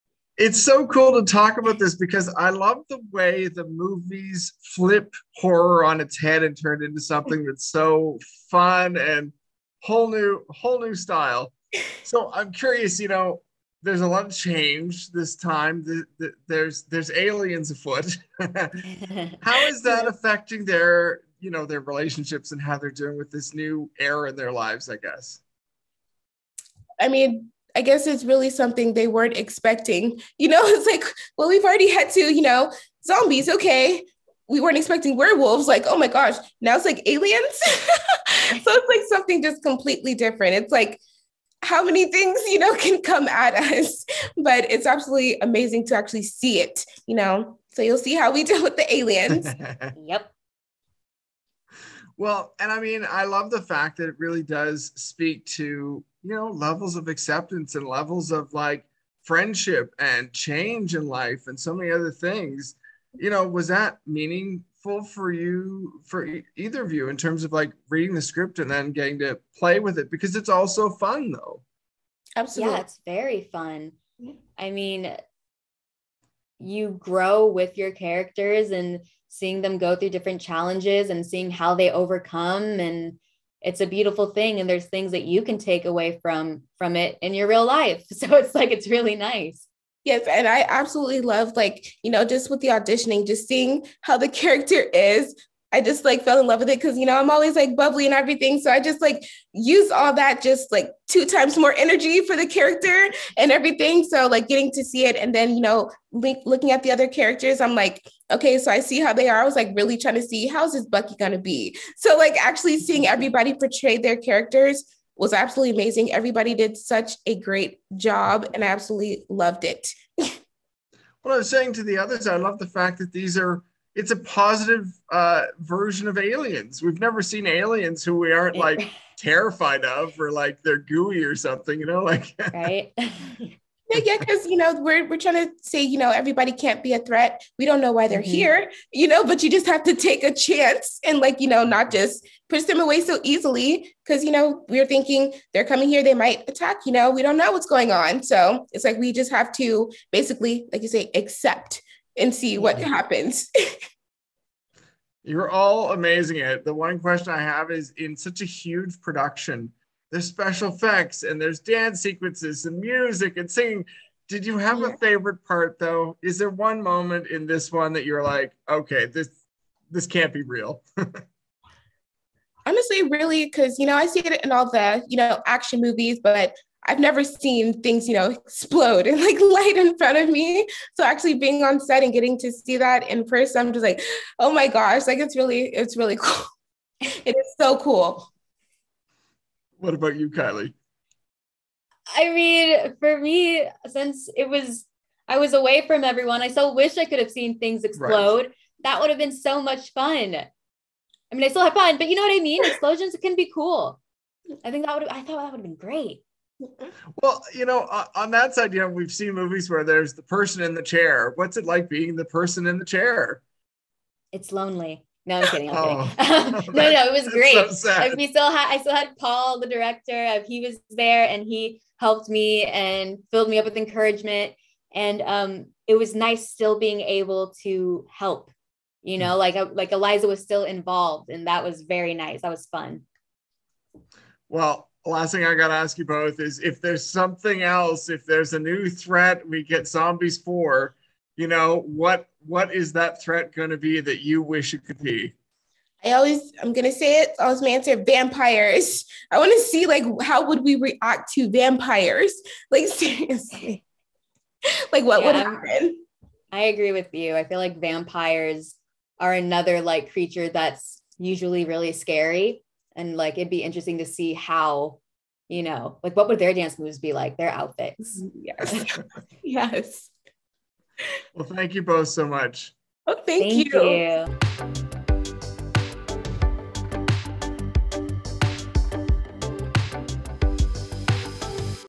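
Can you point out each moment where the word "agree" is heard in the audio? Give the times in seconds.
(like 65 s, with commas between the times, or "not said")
256 s.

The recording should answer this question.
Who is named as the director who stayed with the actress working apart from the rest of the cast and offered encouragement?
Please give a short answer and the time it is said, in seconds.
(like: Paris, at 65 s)
Paul, at 219 s.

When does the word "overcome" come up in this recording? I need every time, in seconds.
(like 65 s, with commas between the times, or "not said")
81 s.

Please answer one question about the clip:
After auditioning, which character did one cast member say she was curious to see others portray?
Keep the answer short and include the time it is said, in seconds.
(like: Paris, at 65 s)
Bucky, at 110 s.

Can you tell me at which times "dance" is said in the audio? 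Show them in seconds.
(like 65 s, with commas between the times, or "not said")
161 s, 266 s.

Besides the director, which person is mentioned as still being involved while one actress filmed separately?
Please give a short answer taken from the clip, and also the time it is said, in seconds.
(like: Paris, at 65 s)
Eliza, at 229 s.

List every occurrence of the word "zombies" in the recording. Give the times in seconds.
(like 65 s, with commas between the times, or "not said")
33 s, 239 s.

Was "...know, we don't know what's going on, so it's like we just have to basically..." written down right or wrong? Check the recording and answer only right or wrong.
right.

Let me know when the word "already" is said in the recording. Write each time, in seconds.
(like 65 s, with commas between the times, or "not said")
31 s.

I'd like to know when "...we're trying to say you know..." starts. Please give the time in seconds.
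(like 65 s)
135 s.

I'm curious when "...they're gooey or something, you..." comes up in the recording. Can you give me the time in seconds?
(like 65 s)
130 s.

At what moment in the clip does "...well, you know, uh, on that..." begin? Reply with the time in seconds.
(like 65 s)
207 s.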